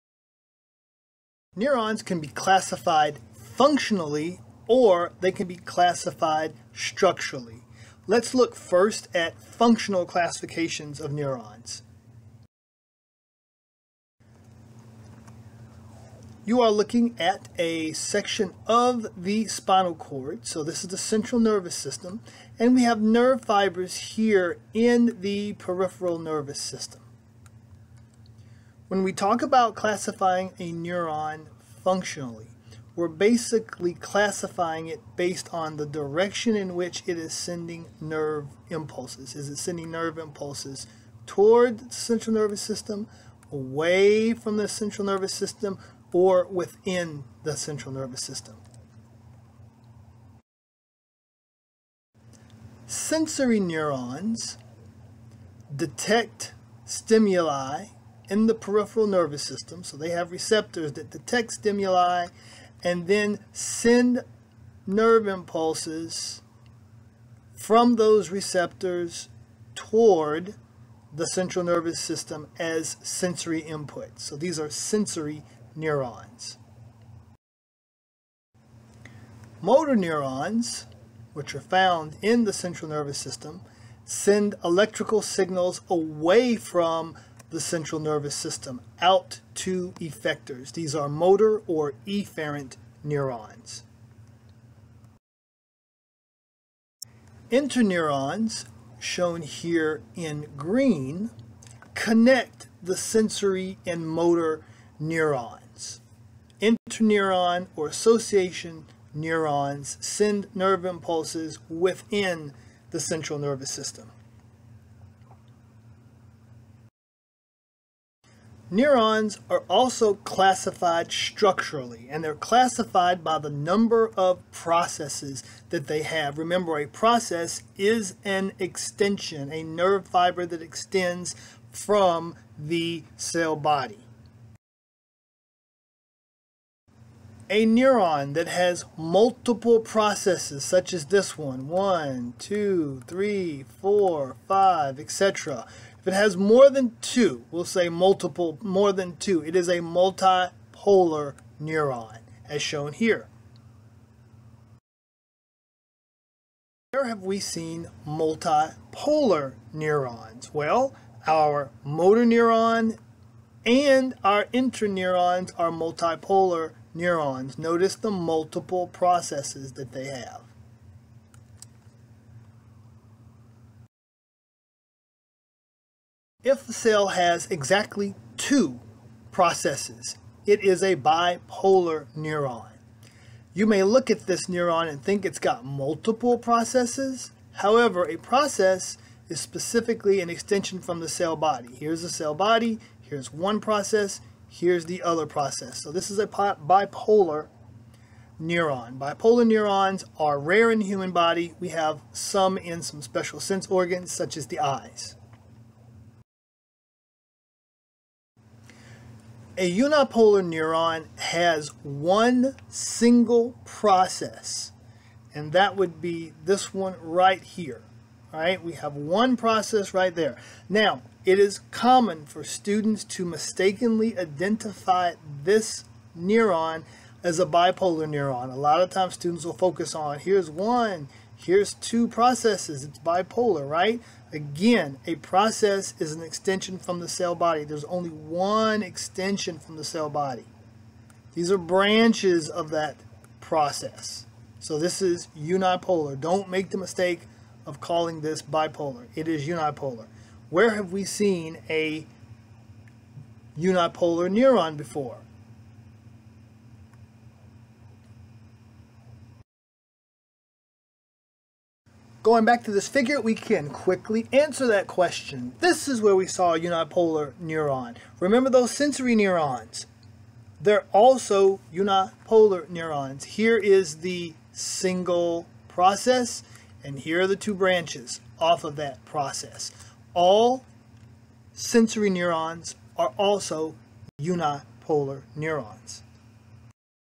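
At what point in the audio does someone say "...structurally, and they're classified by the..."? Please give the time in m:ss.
2:01.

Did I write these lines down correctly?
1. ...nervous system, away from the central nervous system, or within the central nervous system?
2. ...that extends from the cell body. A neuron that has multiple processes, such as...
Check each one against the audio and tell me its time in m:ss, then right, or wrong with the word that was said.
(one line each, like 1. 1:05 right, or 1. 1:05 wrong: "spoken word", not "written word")
1. 0:42 right
2. 2:10 right.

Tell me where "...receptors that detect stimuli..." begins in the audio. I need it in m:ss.
1:00.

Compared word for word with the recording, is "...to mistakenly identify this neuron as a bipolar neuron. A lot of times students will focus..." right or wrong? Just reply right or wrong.
right.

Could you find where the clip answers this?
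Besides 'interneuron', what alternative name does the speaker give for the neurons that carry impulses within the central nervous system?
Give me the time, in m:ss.
1:47.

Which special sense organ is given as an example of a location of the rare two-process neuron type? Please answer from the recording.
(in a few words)
The eyes.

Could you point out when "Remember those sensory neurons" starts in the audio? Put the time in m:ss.
4:28.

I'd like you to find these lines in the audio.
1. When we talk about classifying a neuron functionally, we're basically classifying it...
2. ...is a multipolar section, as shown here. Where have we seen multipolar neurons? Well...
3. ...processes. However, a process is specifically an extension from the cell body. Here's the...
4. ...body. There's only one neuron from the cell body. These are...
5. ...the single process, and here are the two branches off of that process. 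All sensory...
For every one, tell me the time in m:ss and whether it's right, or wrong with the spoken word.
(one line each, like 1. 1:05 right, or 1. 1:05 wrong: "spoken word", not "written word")
1. 0:28 right
2. 2:29 wrong: "neuron", not "section"
3. 3:06 right
4. 3:57 wrong: "extension", not "neuron"
5. 4:33 right.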